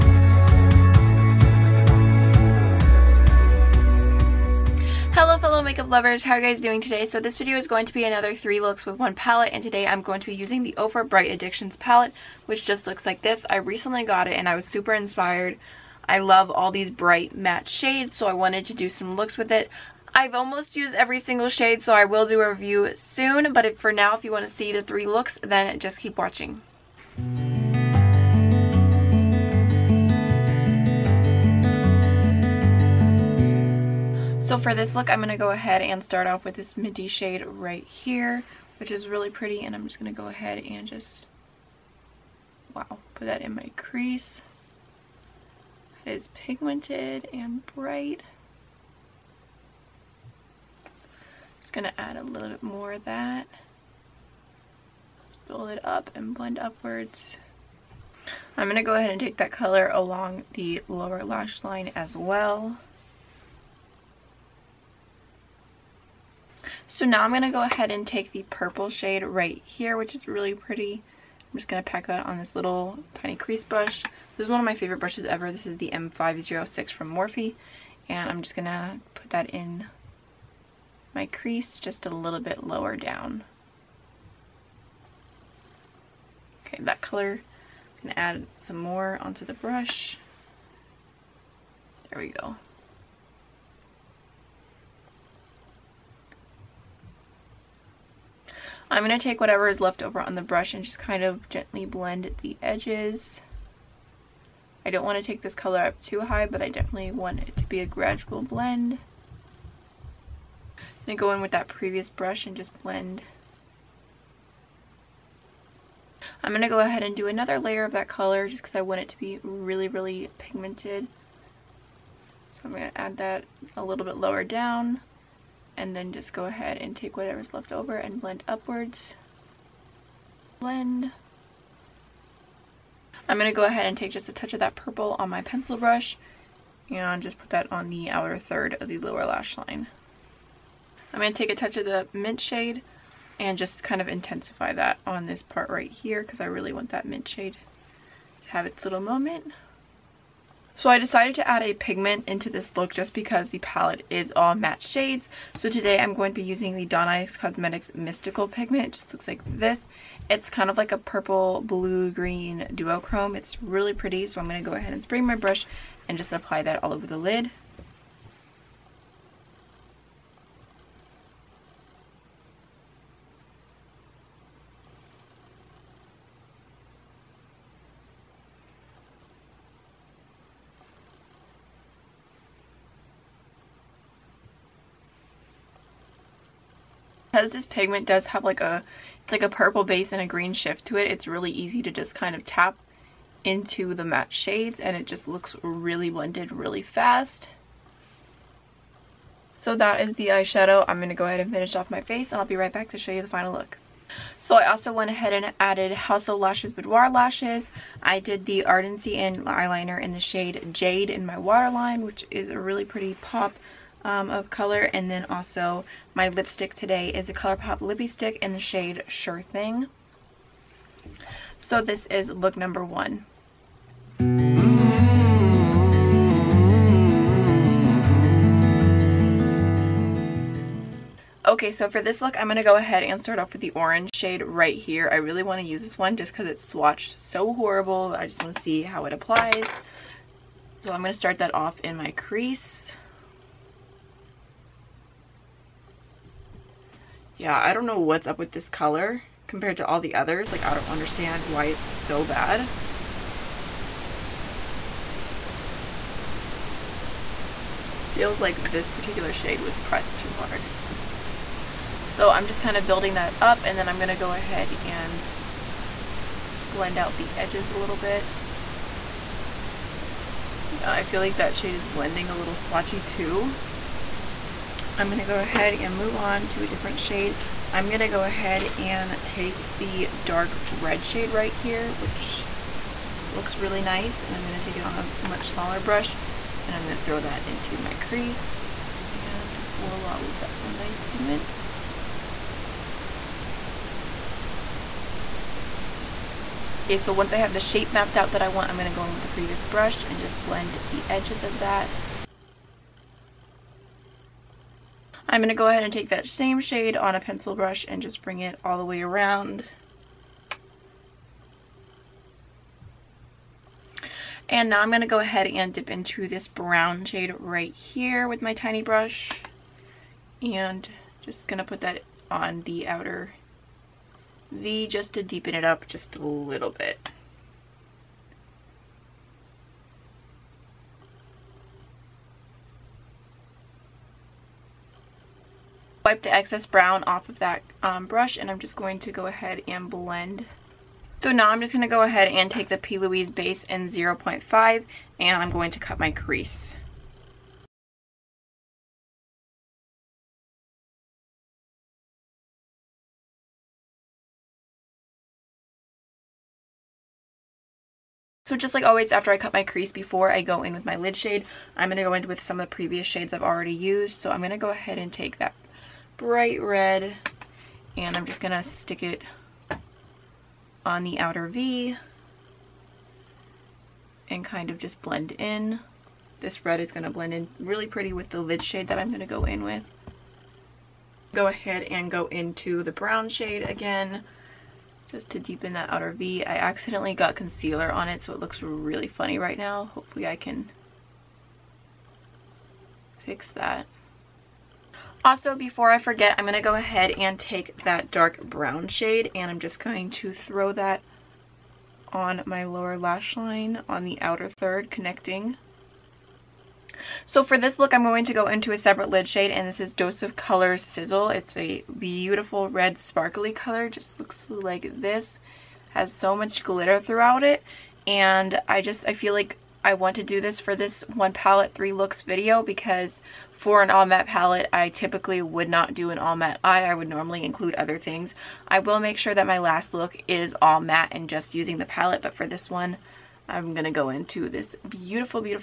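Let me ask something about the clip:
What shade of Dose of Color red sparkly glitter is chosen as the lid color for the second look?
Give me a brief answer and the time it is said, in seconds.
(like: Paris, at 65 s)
Sizzle, at 410 s.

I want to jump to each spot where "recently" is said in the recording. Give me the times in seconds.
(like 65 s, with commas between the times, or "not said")
13 s.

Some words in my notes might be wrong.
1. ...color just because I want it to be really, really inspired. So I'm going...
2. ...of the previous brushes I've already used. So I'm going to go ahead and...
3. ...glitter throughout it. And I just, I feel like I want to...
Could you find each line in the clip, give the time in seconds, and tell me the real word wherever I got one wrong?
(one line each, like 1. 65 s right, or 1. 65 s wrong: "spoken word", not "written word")
1. 118 s wrong: "pigmented", not "inspired"
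2. 362 s wrong: "shades", not "brushes"
3. 416 s right.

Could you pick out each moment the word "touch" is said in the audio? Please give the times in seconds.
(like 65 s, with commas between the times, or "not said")
134 s, 141 s.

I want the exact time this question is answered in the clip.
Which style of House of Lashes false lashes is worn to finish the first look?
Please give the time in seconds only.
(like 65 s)
206 s.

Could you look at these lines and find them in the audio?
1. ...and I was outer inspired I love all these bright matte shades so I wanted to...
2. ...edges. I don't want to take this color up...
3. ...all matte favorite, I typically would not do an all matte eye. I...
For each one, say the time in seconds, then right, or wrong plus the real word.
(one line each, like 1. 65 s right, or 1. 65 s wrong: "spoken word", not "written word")
1. 14 s wrong: "super", not "outer"
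2. 102 s right
3. 423 s wrong: "palette", not "favorite".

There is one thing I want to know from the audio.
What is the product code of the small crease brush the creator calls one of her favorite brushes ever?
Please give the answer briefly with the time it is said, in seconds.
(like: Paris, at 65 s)
M506, at 75 s.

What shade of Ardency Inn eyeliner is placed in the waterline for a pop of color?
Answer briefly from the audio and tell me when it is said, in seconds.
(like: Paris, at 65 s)
Jade, at 210 s.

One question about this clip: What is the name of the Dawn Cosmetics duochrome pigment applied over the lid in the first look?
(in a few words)
Mystical Pigment.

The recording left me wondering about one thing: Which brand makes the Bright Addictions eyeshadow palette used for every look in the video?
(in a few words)
Ofra.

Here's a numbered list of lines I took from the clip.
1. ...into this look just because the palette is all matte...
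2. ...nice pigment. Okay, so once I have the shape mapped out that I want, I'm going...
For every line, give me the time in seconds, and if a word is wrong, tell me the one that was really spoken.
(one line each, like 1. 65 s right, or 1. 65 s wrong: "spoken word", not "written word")
1. 152 s right
2. 290 s right.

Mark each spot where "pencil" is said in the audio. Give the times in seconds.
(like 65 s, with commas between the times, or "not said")
135 s, 307 s.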